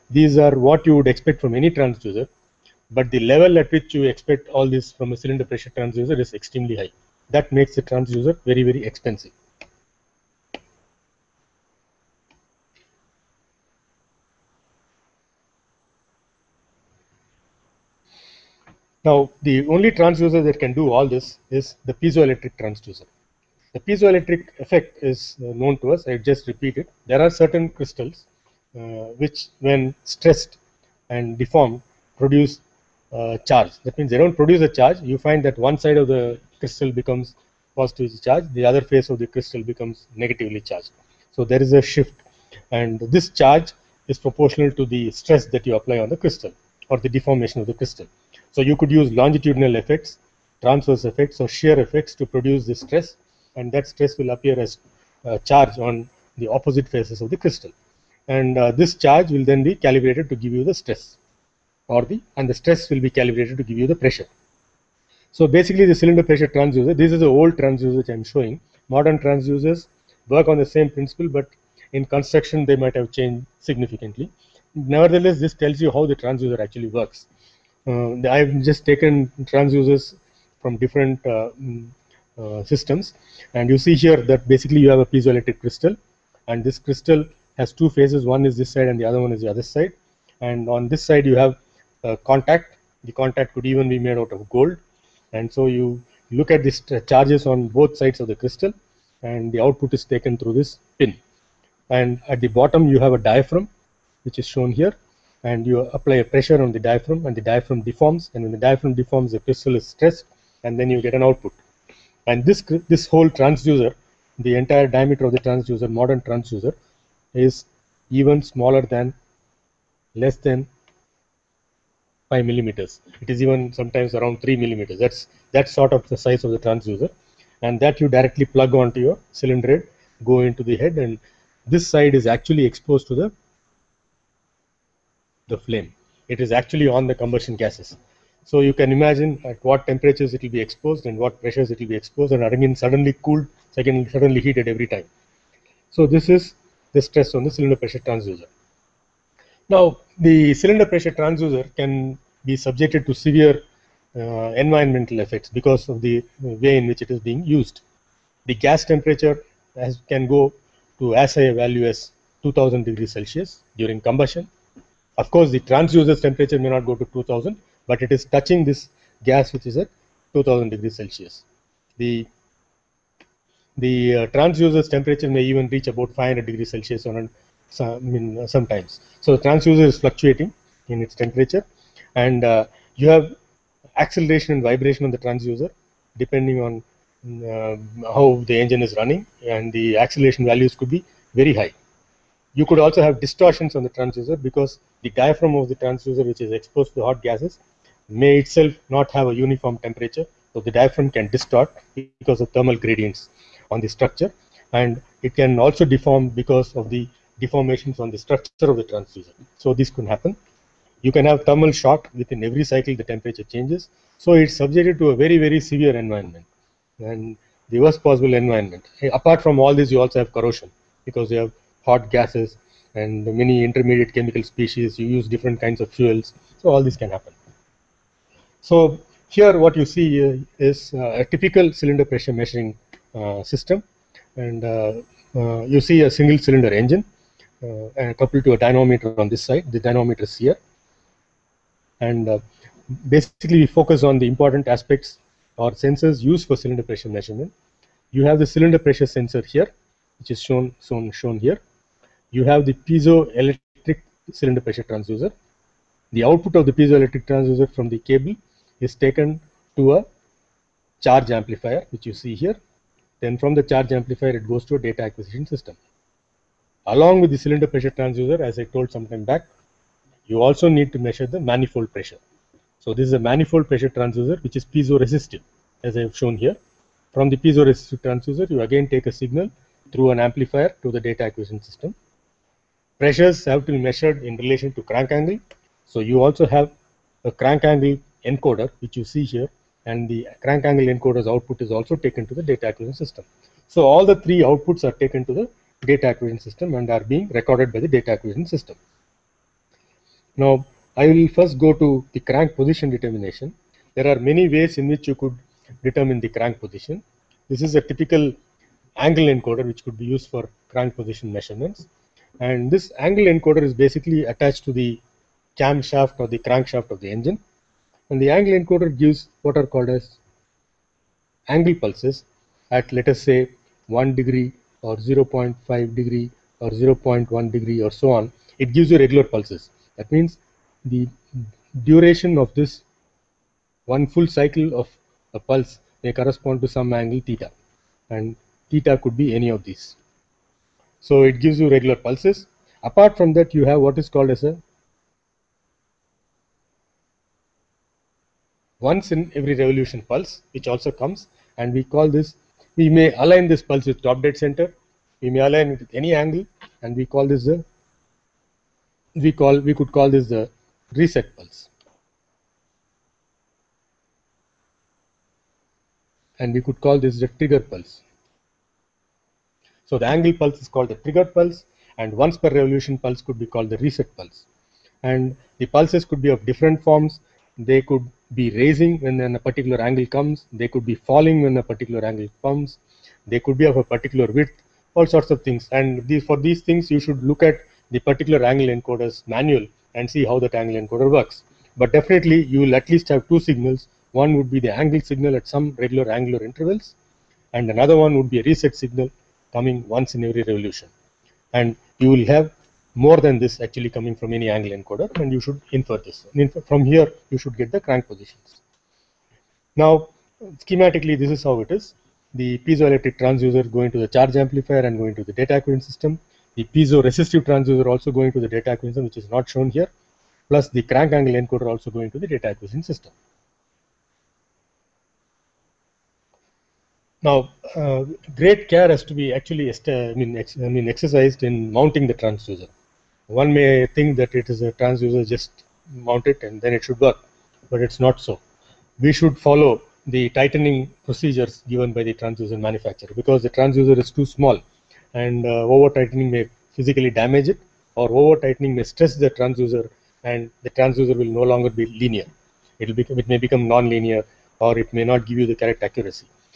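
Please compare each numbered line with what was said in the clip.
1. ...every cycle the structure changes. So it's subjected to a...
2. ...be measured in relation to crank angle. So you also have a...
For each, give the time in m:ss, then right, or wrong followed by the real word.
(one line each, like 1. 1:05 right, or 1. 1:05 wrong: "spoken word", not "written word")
1. 3:32 wrong: "temperature", not "structure"
2. 4:43 right.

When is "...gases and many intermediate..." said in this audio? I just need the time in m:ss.
3:42.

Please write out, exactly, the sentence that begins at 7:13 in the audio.
One may think that it is a transducer, just mount it and then it should work, but it's not so.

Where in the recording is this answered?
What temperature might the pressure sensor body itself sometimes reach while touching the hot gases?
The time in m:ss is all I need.
2:56.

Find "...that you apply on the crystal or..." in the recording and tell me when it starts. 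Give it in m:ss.
0:45.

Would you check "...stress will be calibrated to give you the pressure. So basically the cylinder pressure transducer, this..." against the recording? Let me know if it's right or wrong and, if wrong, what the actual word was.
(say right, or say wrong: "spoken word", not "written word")
right.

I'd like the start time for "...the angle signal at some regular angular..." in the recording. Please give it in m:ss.
6:34.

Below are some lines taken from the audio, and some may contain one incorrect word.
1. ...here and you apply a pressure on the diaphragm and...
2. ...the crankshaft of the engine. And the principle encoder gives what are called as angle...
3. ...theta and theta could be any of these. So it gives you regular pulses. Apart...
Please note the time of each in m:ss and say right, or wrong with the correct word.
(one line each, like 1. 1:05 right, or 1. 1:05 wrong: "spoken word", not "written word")
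1. 1:44 right
2. 5:16 wrong: "angle", not "principle"
3. 5:37 right.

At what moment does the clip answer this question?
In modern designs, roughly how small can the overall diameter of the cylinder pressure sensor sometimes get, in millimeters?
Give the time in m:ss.
2:04.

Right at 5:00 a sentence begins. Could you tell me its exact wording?
Now, I will first go to the crank position determination.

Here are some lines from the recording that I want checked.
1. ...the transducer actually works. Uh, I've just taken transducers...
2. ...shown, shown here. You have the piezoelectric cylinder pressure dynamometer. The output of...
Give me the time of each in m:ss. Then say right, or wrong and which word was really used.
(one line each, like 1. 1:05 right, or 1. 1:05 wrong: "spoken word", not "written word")
1. 1:16 right
2. 4:10 wrong: "transducer", not "dynamometer".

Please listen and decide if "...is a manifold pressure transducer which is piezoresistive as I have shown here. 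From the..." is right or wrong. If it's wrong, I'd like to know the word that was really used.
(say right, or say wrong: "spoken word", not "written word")
right.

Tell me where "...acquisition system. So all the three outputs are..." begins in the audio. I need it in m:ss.
4:52.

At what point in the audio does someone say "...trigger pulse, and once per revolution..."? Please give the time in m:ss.
6:10.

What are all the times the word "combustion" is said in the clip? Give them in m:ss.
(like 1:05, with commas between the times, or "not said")
2:17, 2:43.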